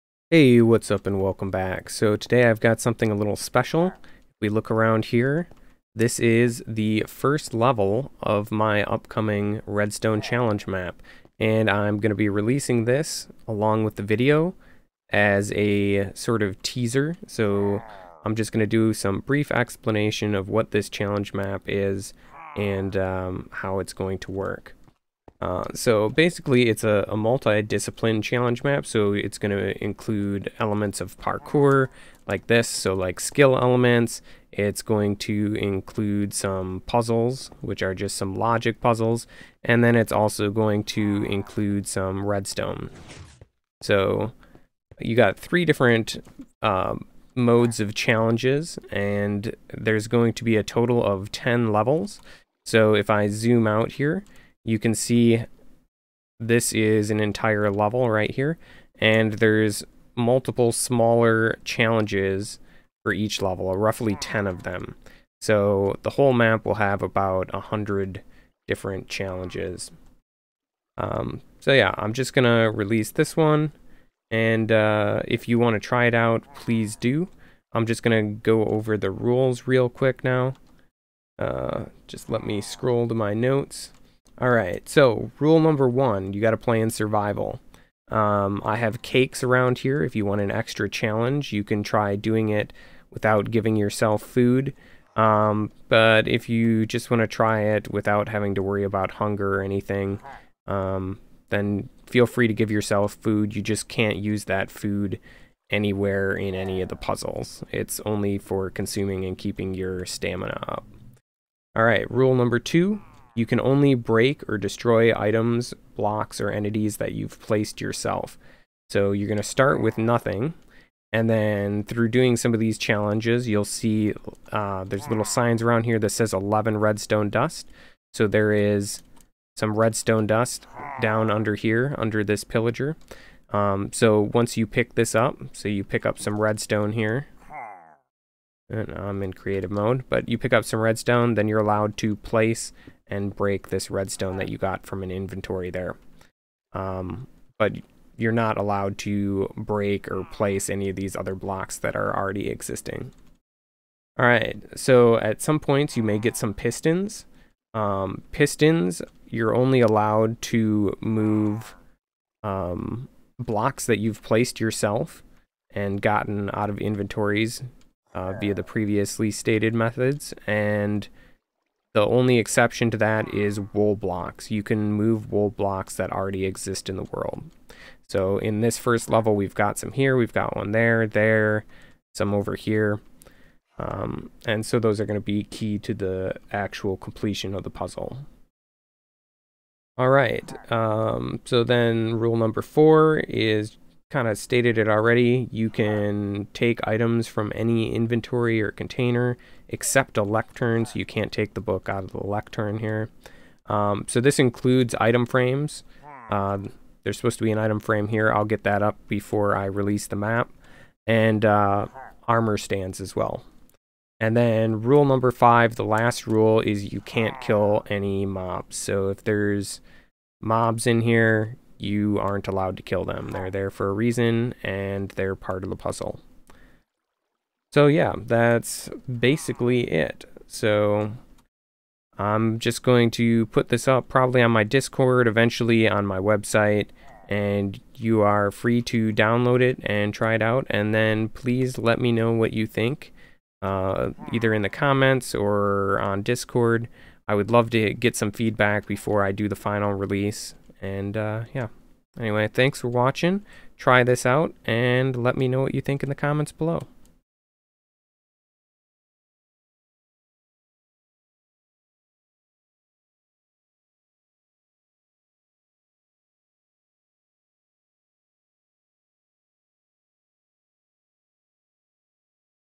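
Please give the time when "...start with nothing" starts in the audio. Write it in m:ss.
1:59.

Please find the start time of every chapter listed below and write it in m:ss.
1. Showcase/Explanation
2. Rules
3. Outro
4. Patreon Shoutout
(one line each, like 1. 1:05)
1. 0:17
2. 1:23
3. 3:46
4. 4:17.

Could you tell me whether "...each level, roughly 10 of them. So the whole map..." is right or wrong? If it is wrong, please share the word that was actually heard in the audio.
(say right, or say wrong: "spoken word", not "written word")
right.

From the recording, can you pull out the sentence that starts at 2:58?
So in this first level, we've got some here, we've got one there, there, some over here.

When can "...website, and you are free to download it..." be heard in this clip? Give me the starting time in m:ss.
3:56.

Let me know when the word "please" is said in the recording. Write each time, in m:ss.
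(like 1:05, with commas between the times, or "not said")
1:16, 4:01.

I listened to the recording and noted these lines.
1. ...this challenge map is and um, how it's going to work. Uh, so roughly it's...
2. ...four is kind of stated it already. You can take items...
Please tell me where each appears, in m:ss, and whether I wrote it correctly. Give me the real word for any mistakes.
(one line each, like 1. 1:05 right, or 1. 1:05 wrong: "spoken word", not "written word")
1. 0:20 wrong: "basically", not "roughly"
2. 3:12 right.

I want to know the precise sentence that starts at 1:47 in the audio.
It's only for consuming and keeping your stamina up.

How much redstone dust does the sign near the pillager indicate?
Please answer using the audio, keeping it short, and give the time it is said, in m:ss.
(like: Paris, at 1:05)
11, at 2:06.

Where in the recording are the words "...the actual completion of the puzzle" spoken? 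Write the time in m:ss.
3:05.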